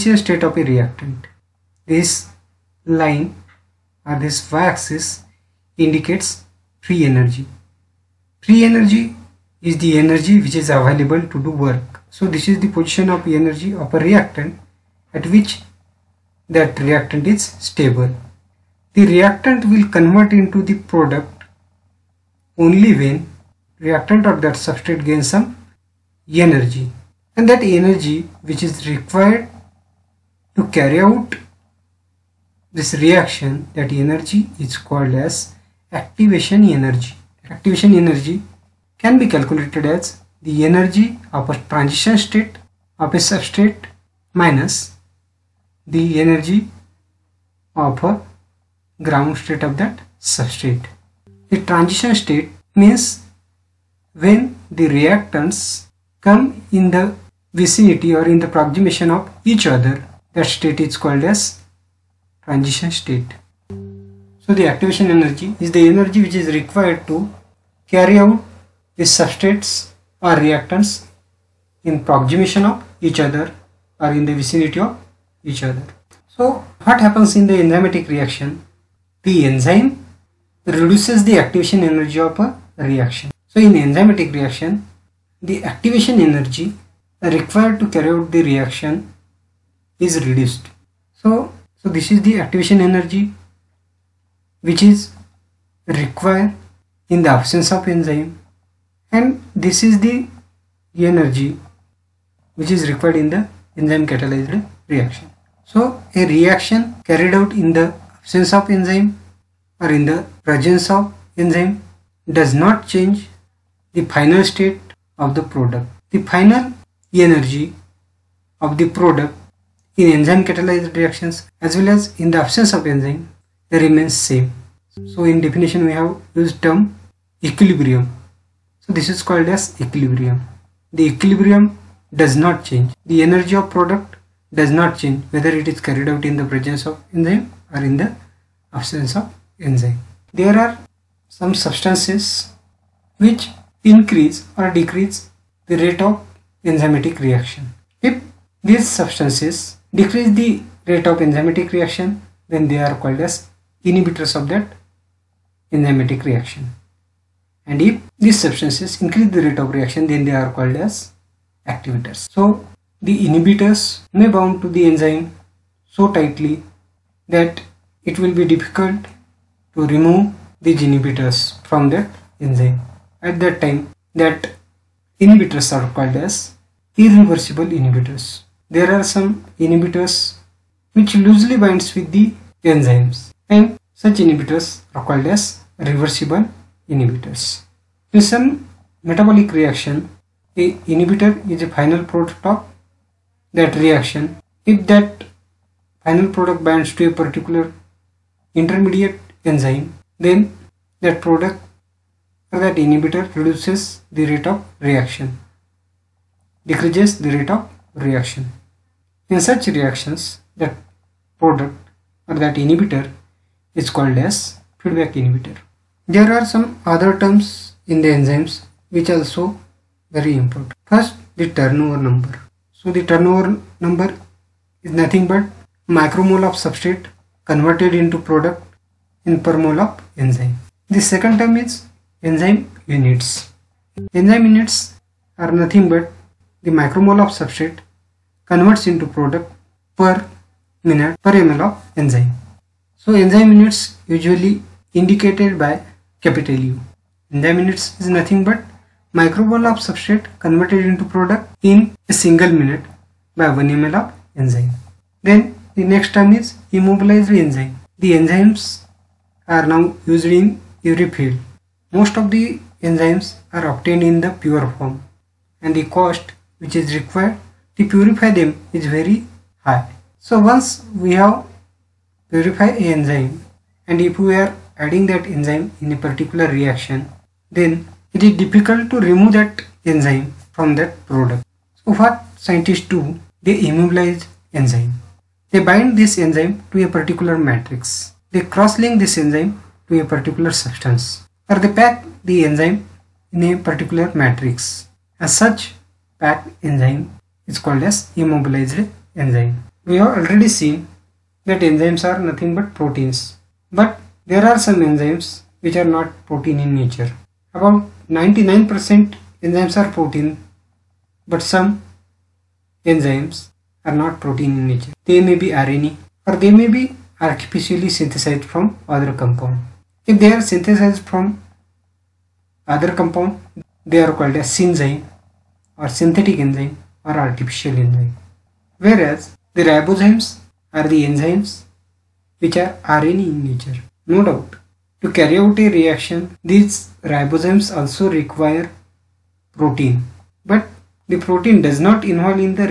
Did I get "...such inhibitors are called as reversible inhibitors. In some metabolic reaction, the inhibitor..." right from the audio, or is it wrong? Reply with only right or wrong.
right.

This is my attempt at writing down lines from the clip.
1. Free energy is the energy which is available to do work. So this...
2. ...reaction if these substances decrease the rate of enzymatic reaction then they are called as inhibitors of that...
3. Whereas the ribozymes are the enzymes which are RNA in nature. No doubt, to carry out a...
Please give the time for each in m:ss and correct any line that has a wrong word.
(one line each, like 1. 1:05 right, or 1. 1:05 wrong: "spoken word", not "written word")
1. 0:08 right
2. 2:27 right
3. 5:28 right.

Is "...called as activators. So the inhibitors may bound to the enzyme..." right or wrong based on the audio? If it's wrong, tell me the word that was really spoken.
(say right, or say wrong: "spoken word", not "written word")
right.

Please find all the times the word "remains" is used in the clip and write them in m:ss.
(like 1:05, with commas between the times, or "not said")
2:03.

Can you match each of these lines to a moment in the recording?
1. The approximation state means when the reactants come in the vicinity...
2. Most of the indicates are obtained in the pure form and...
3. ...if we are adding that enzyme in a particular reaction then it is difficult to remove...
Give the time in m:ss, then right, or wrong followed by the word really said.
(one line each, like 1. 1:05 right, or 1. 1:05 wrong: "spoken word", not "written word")
1. 0:51 wrong: "transition", not "approximation"
2. 4:21 wrong: "enzymes", not "indicates"
3. 4:34 right.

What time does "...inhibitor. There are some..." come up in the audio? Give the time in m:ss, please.
3:35.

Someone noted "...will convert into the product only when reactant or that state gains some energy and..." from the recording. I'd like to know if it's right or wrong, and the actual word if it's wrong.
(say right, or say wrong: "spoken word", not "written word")
wrong: "substrate", not "state".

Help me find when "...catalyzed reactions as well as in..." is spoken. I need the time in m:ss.
2:00.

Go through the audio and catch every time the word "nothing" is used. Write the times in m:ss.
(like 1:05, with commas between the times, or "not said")
3:44, 3:55, 4:08, 5:02.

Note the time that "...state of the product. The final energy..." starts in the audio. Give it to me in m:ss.
1:54.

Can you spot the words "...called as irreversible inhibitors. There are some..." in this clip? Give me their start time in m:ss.
2:55.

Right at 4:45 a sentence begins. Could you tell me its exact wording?
They bind this enzyme to a particular matrix.